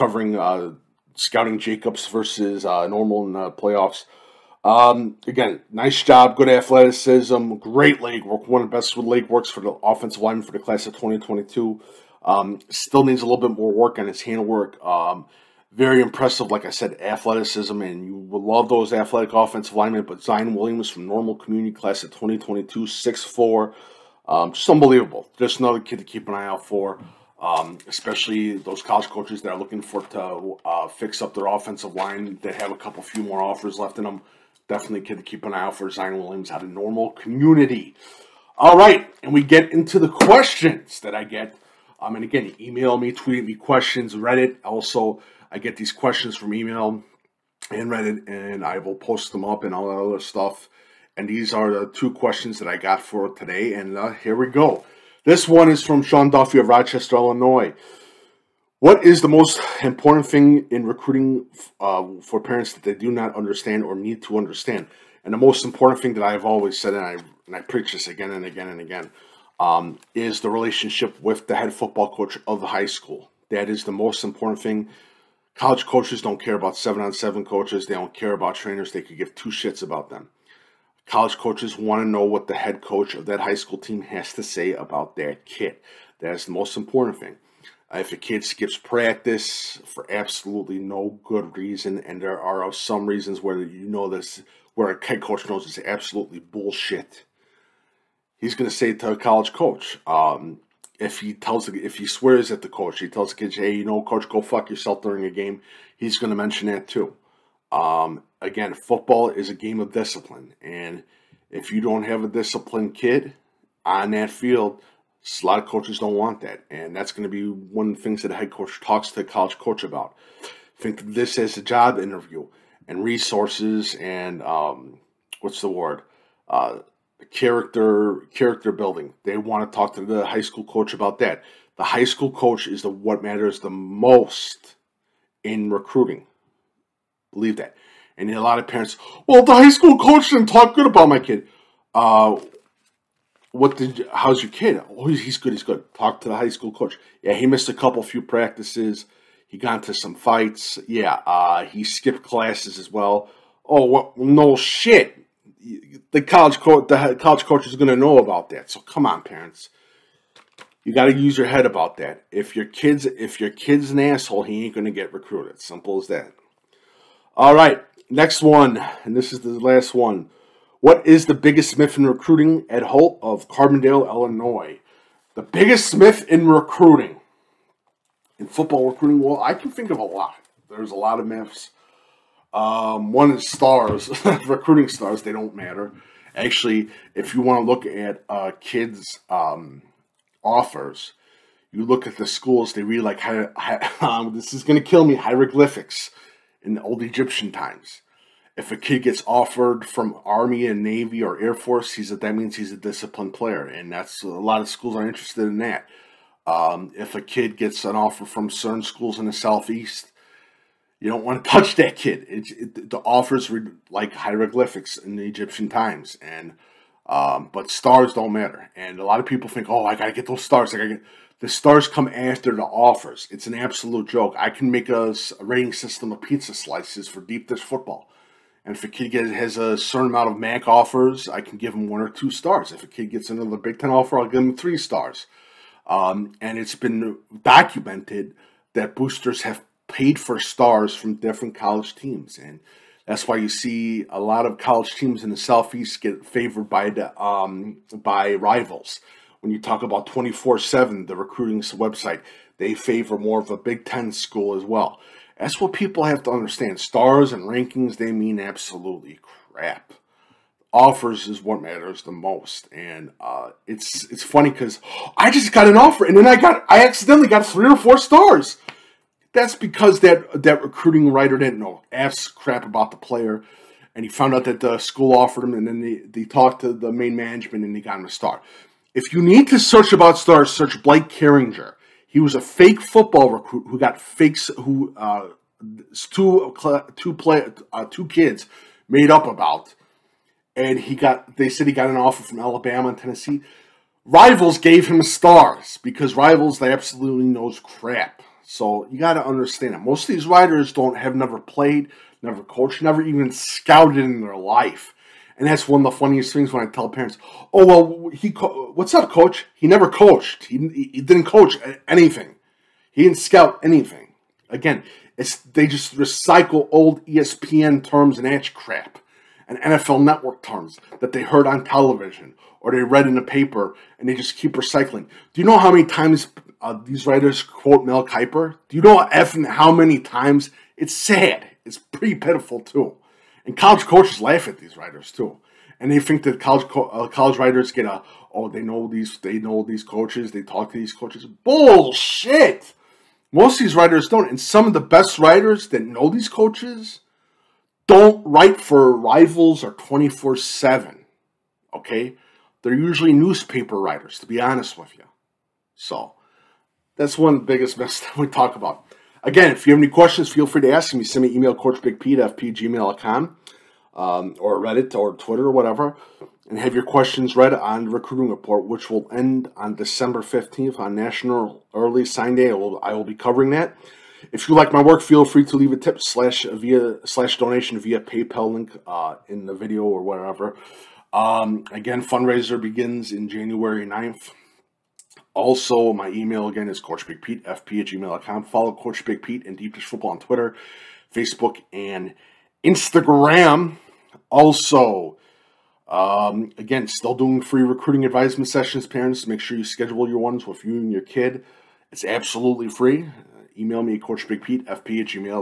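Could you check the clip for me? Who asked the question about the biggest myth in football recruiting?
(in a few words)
Ed Holt.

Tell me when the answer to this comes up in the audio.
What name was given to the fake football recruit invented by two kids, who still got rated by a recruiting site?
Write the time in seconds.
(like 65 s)
280 s.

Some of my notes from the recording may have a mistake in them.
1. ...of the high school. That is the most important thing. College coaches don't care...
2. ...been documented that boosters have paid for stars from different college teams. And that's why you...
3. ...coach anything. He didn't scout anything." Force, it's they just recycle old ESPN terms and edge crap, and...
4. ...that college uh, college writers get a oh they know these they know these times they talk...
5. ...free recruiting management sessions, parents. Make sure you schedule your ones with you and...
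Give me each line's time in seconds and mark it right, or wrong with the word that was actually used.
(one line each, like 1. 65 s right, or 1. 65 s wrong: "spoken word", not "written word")
1. 72 s right
2. 236 s right
3. 311 s wrong: "Again", not "Force"
4. 336 s wrong: "coaches", not "times"
5. 397 s wrong: "advisement", not "management".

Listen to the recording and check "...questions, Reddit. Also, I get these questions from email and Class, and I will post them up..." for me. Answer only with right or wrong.
wrong.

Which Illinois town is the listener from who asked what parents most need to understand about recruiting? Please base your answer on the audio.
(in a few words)
Rochester.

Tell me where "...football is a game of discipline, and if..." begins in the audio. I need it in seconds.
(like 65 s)
108 s.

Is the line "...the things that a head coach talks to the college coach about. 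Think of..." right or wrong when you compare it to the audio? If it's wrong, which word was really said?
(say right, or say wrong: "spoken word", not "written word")
right.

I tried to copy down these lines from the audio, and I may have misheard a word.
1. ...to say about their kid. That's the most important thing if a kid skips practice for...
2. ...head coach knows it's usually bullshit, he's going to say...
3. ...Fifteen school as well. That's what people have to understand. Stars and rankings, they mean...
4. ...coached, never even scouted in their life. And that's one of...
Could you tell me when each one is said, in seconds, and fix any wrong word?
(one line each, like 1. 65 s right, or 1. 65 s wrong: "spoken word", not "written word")
1. 84 s right
2. 95 s wrong: "absolutely", not "usually"
3. 253 s wrong: "Ten", not "Fifteen"
4. 302 s right.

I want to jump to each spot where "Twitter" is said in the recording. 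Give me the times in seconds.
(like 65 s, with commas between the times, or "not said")
365 s, 390 s.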